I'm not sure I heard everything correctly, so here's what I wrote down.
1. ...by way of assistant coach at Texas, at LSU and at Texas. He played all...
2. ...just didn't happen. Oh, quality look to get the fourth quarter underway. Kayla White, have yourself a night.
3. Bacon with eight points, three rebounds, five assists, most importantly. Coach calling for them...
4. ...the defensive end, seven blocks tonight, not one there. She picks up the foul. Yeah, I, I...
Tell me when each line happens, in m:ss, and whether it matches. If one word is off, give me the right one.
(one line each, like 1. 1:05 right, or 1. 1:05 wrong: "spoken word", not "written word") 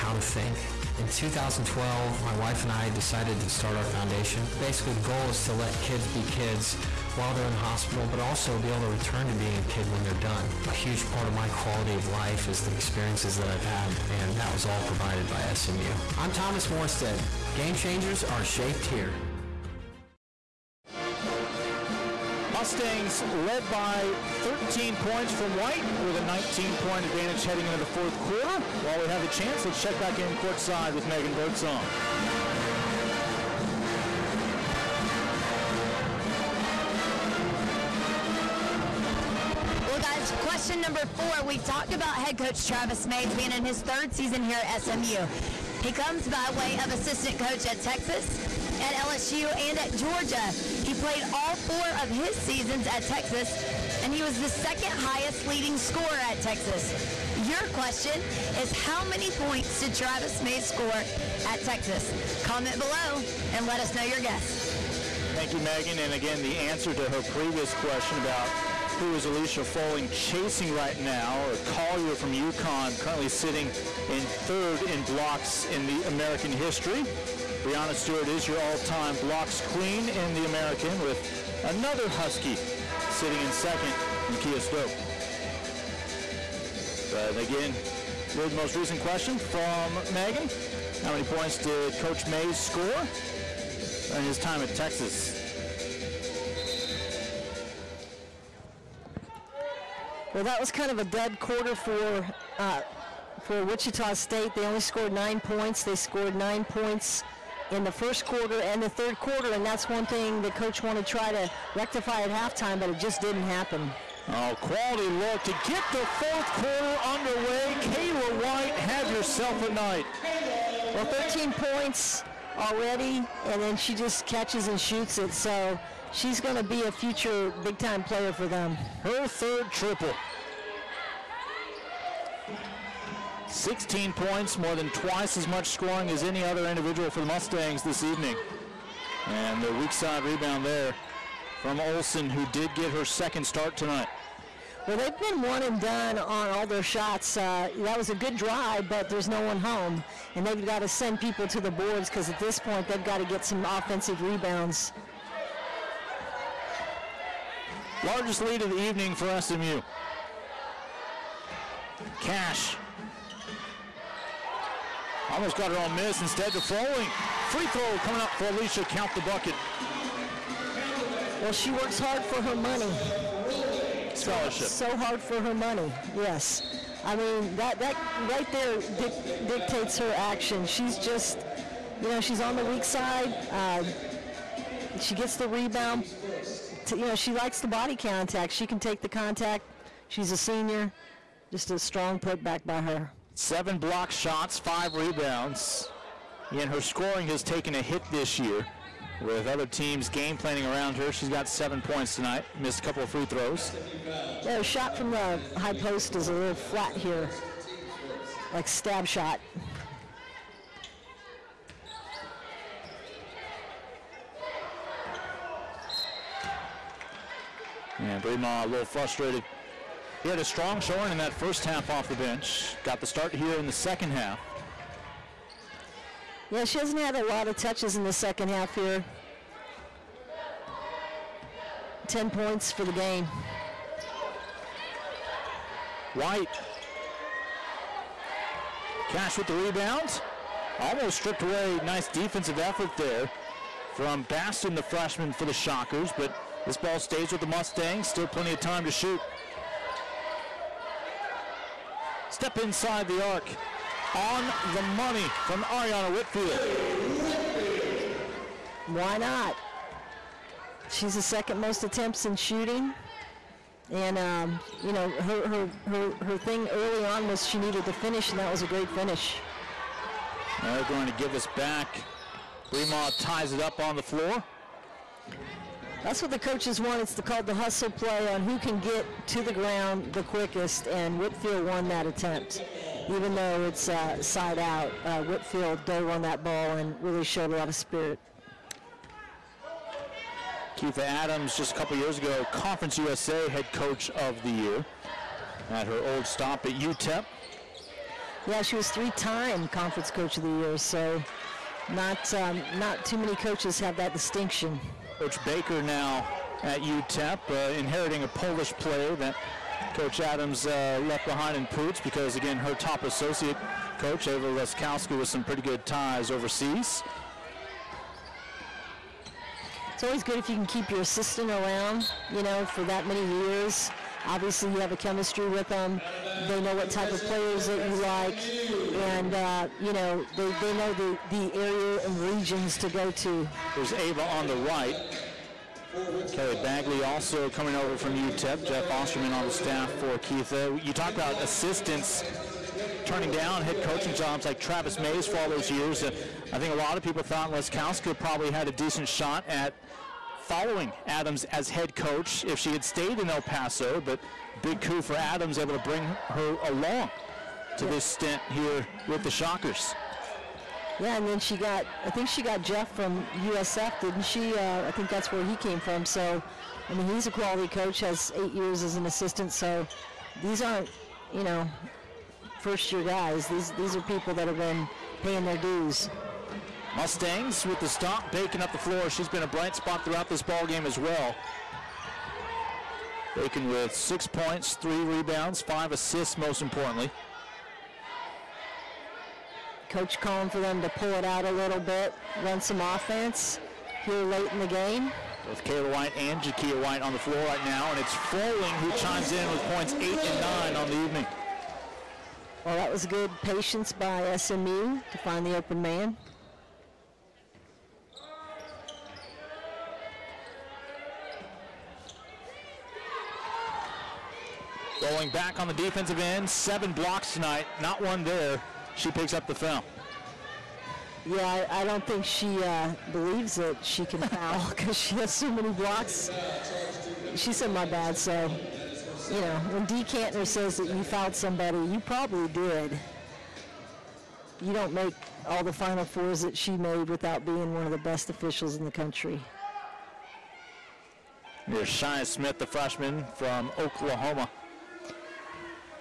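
1. 0:46 wrong: "Georgia", not "Texas"
2. 1:52 right
3. 6:23 wrong: "six", not "eight"
4. 6:55 right.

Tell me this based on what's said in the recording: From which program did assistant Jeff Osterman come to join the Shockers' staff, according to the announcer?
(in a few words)
USF.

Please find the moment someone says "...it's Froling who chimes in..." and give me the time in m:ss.
6:37.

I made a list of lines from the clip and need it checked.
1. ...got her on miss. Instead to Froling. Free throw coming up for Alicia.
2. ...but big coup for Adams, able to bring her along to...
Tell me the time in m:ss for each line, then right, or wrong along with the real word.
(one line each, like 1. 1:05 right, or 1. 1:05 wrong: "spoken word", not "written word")
1. 2:45 right
2. 5:54 right.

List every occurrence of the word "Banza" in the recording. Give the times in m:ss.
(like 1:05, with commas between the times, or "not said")
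not said.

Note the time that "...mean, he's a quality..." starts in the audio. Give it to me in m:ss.
6:06.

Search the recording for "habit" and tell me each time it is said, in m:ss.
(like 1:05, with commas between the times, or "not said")
not said.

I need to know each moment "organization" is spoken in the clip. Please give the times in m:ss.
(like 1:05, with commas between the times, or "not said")
not said.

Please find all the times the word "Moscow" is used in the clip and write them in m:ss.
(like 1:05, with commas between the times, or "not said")
not said.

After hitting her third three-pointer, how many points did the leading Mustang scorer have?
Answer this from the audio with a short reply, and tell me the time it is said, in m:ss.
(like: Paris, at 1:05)
16, at 2:13.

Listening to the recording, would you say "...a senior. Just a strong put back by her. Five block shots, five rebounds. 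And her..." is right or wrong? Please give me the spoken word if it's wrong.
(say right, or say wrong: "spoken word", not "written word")
wrong: "Seven", not "Five".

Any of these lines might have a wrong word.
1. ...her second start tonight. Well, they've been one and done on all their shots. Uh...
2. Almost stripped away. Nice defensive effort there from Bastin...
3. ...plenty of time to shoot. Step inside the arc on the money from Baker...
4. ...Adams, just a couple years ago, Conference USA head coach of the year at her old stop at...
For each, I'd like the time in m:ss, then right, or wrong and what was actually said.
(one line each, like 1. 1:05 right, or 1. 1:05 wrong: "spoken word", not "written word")
1. 2:22 right
2. 4:00 right
3. 4:08 wrong: "Ariana", not "Baker"
4. 4:51 right.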